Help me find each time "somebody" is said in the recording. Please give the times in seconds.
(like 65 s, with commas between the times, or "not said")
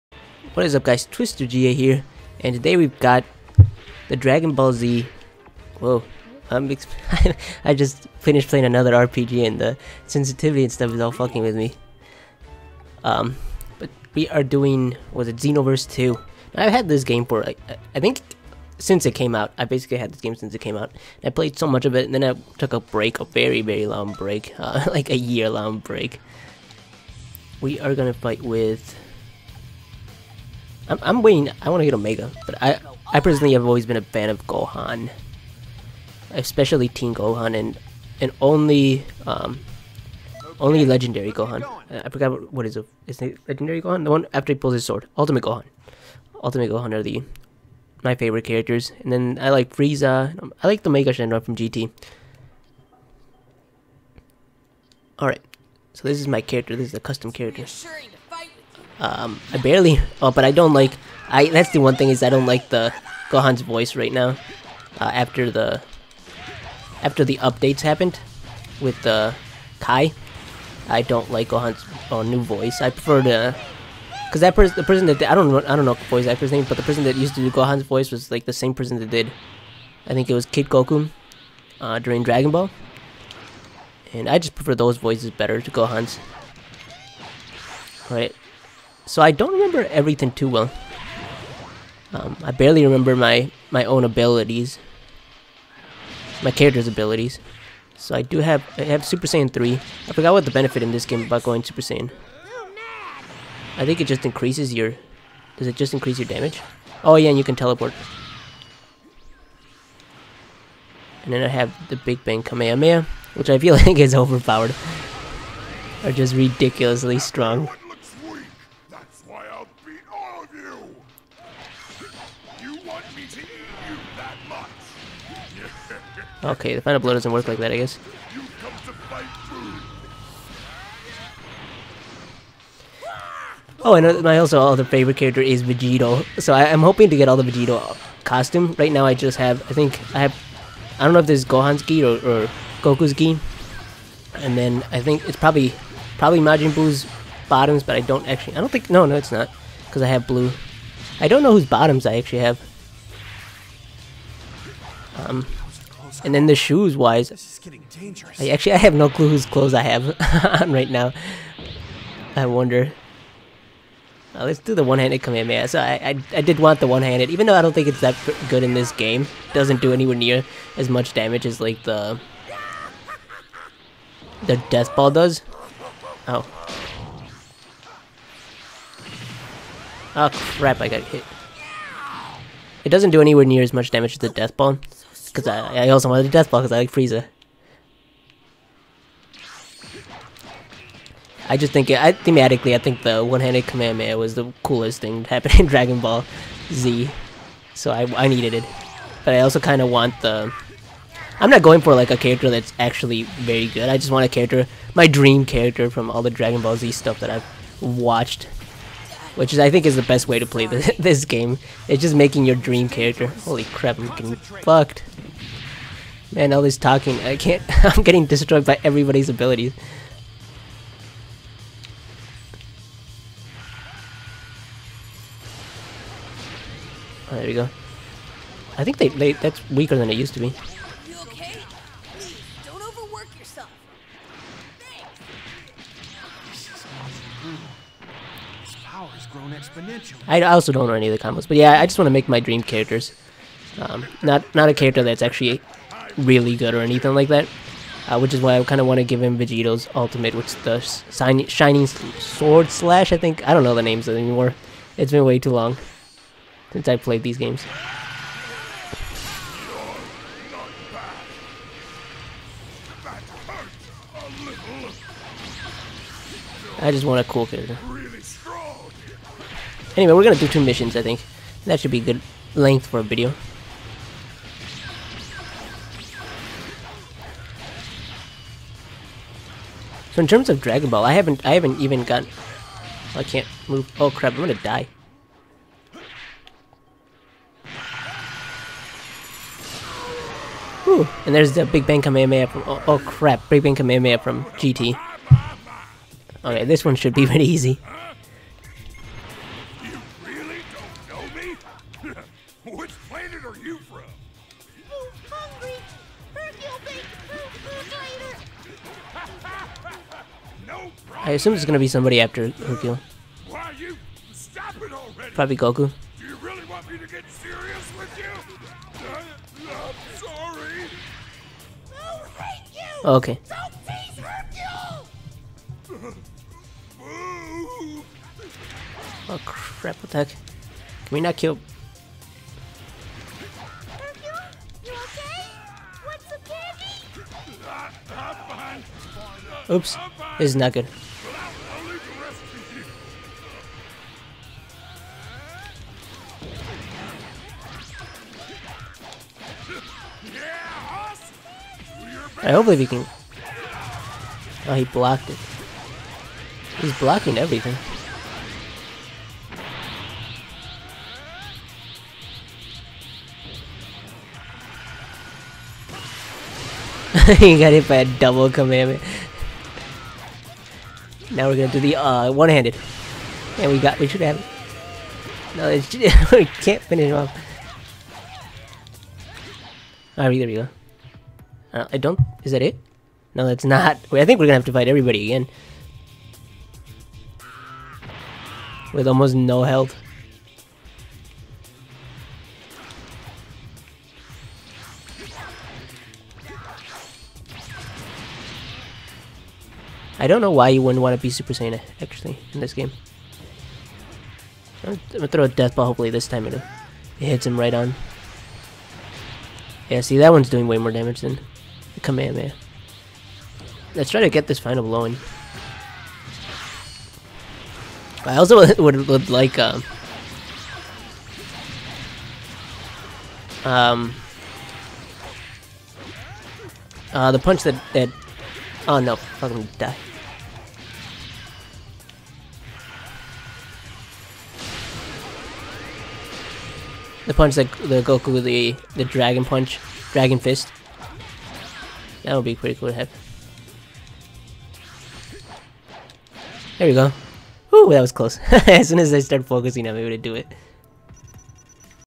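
311 s.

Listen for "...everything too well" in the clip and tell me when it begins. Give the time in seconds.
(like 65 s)
89 s.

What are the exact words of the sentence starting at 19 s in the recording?
I basically had this game since it came out.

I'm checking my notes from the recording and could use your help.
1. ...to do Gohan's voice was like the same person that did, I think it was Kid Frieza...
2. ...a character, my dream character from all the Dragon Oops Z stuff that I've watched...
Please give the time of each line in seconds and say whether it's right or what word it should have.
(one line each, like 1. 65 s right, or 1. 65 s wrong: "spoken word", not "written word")
1. 77 s wrong: "Goku", not "Frieza"
2. 204 s wrong: "Ball", not "Oops".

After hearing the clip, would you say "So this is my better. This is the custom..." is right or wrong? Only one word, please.
wrong.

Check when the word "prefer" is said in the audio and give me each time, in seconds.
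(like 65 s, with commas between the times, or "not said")
72 s, 84 s.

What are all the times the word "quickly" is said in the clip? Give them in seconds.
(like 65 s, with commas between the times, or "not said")
not said.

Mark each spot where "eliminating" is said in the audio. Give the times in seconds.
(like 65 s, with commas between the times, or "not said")
not said.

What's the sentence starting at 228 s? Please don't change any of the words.
I think they, they that's weaker than it used to be.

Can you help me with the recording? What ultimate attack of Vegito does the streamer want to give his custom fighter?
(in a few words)
Shining Sword Slash.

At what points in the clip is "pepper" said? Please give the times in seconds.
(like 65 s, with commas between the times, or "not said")
not said.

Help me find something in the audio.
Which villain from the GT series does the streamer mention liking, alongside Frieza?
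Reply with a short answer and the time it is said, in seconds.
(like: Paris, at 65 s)
Mega Shenron, at 50 s.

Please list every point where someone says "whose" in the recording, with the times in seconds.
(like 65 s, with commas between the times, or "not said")
151 s, 159 s.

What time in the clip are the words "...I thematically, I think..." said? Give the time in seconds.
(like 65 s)
191 s.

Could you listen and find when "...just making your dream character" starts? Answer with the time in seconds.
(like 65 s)
212 s.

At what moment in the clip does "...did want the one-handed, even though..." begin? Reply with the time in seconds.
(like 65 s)
166 s.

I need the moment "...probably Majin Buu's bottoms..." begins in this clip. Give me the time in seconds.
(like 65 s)
146 s.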